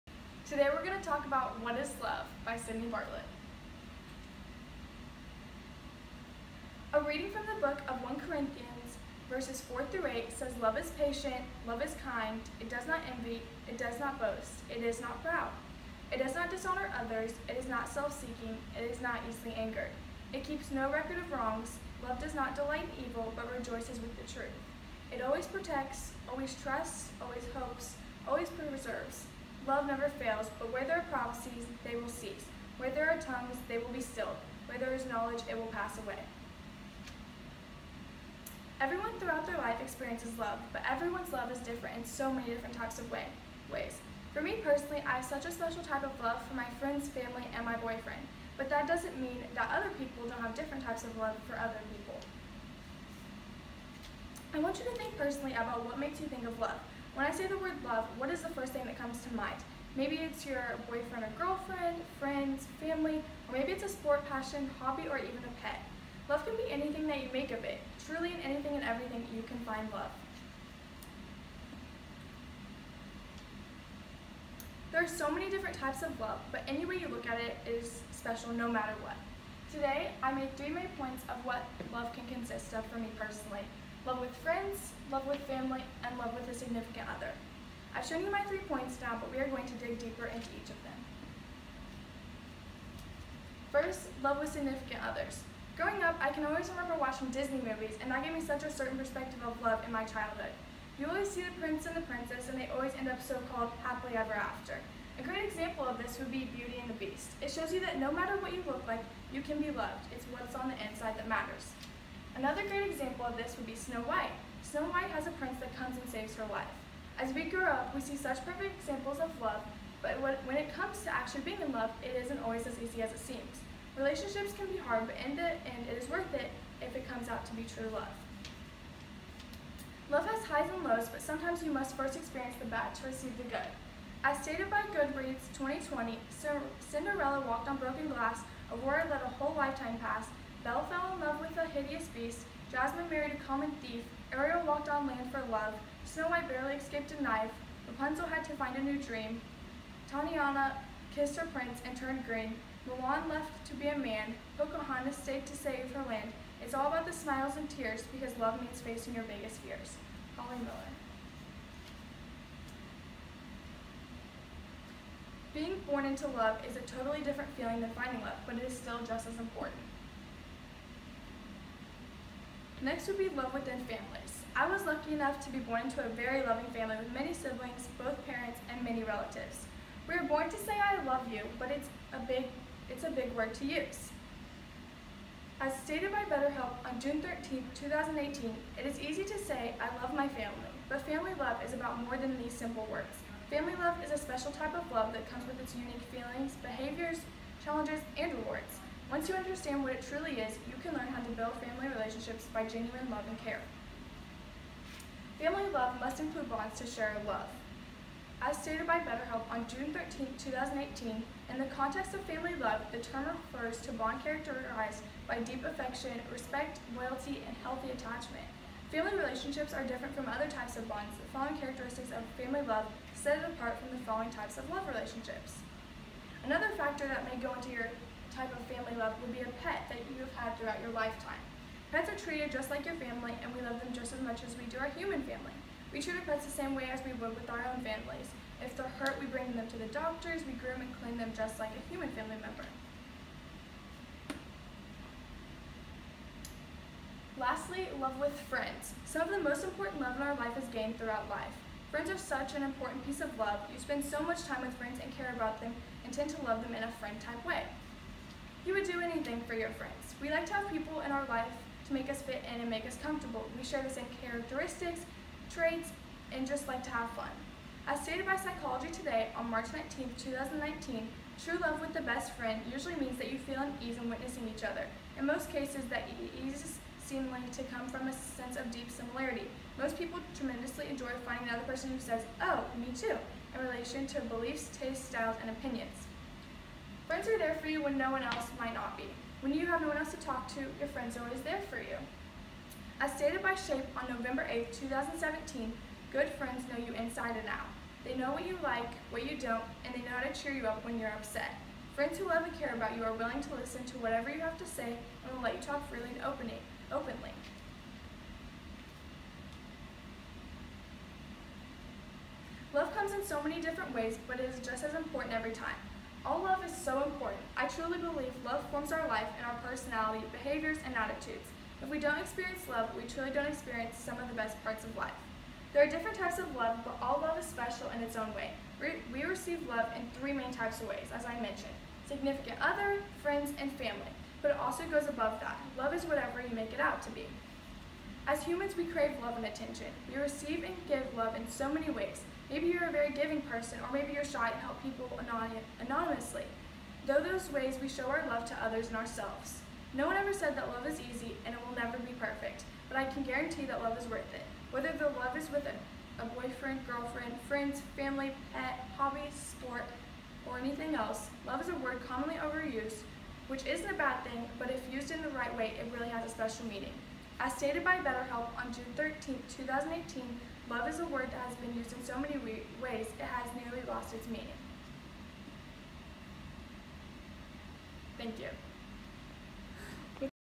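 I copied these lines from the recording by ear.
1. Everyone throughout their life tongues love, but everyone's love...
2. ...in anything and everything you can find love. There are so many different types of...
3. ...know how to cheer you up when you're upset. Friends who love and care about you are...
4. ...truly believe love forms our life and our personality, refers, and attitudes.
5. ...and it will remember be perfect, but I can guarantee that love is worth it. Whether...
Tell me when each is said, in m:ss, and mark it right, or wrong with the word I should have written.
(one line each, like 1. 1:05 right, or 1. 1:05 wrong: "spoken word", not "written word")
1. 0:38 wrong: "experiences", not "tongues"
2. 1:08 right
3. 5:00 right
4. 5:17 wrong: "behaviors", not "refers"
5. 5:51 wrong: "never", not "remember".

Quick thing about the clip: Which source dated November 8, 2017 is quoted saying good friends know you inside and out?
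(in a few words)
Shape.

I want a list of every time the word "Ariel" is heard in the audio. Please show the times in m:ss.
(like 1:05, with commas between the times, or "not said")
2:24.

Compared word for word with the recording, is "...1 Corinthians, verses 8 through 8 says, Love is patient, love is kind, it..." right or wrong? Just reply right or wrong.
wrong.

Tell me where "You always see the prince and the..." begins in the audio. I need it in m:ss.
1:40.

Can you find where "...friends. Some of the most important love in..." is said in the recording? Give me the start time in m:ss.
4:08.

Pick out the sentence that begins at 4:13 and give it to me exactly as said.
You spend so much time with friends and care about them and tend to love them in a friend-type way.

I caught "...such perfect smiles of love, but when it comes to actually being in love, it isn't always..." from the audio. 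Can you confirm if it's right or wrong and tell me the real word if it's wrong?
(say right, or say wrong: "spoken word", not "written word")
wrong: "examples", not "smiles".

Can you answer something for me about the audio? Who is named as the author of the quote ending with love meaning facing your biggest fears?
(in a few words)
Holly Miller.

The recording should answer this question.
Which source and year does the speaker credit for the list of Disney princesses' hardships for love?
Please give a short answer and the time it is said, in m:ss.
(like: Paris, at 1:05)
Goodreads 2020, at 2:14.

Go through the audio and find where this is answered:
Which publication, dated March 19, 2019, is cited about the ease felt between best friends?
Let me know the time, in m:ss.
4:28.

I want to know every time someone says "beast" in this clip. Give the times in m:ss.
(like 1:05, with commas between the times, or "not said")
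1:47, 2:22.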